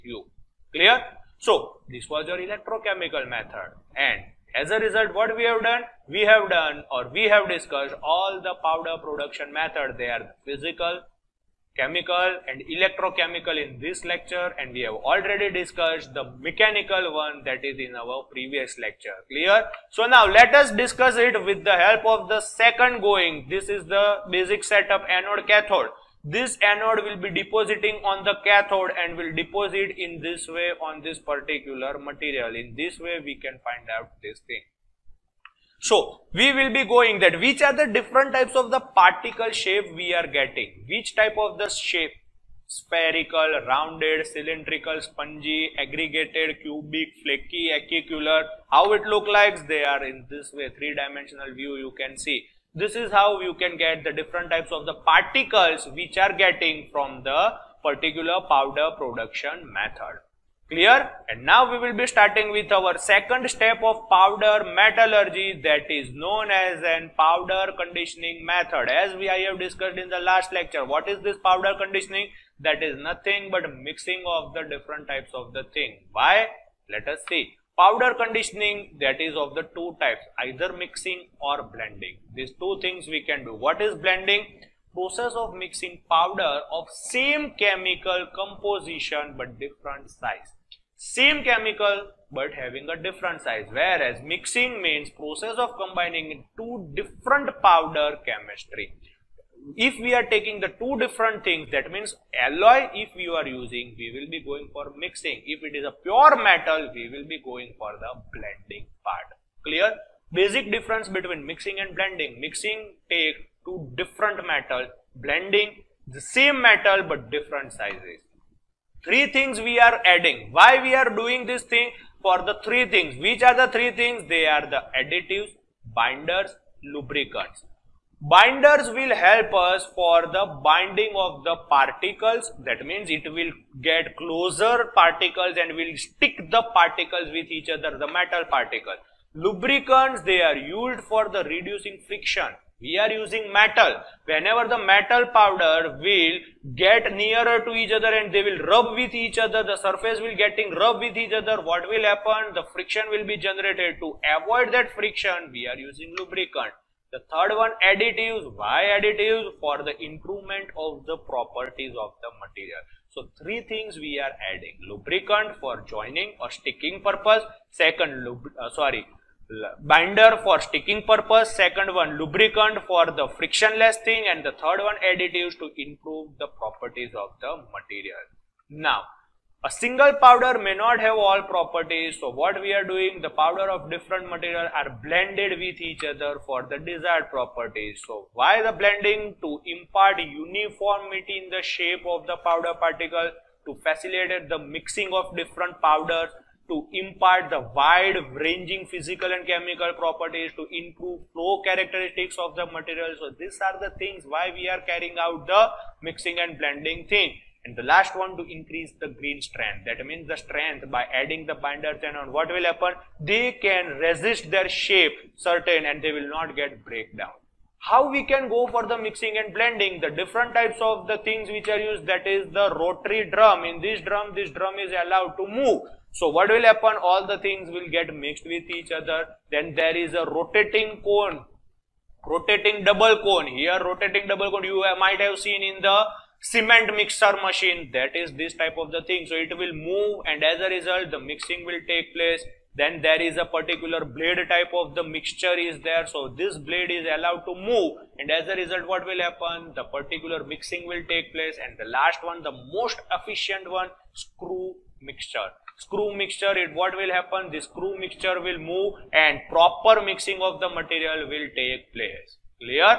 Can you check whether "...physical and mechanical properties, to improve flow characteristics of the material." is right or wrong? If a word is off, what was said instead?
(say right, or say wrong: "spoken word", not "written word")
wrong: "chemical", not "mechanical".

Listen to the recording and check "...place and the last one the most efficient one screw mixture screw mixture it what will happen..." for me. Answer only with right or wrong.
right.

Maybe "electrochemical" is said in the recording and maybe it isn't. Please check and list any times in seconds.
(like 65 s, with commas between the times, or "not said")
2 s, 12 s.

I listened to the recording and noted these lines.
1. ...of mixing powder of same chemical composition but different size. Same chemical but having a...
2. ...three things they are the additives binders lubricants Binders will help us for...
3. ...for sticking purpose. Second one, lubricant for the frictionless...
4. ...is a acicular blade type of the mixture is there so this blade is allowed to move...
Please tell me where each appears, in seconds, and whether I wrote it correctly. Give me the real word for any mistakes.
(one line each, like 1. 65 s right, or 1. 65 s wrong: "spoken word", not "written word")
1. 85 s right
2. 123 s right
3. 170 s right
4. 243 s wrong: "particular", not "acicular".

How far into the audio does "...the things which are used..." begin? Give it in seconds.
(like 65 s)
221 s.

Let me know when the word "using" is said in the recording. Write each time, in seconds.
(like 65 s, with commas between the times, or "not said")
103 s, 143 s, 155 s.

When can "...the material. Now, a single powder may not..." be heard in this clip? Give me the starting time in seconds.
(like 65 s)
177 s.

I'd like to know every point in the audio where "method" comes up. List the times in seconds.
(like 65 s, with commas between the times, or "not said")
3 s, 9 s, 59 s, 68 s.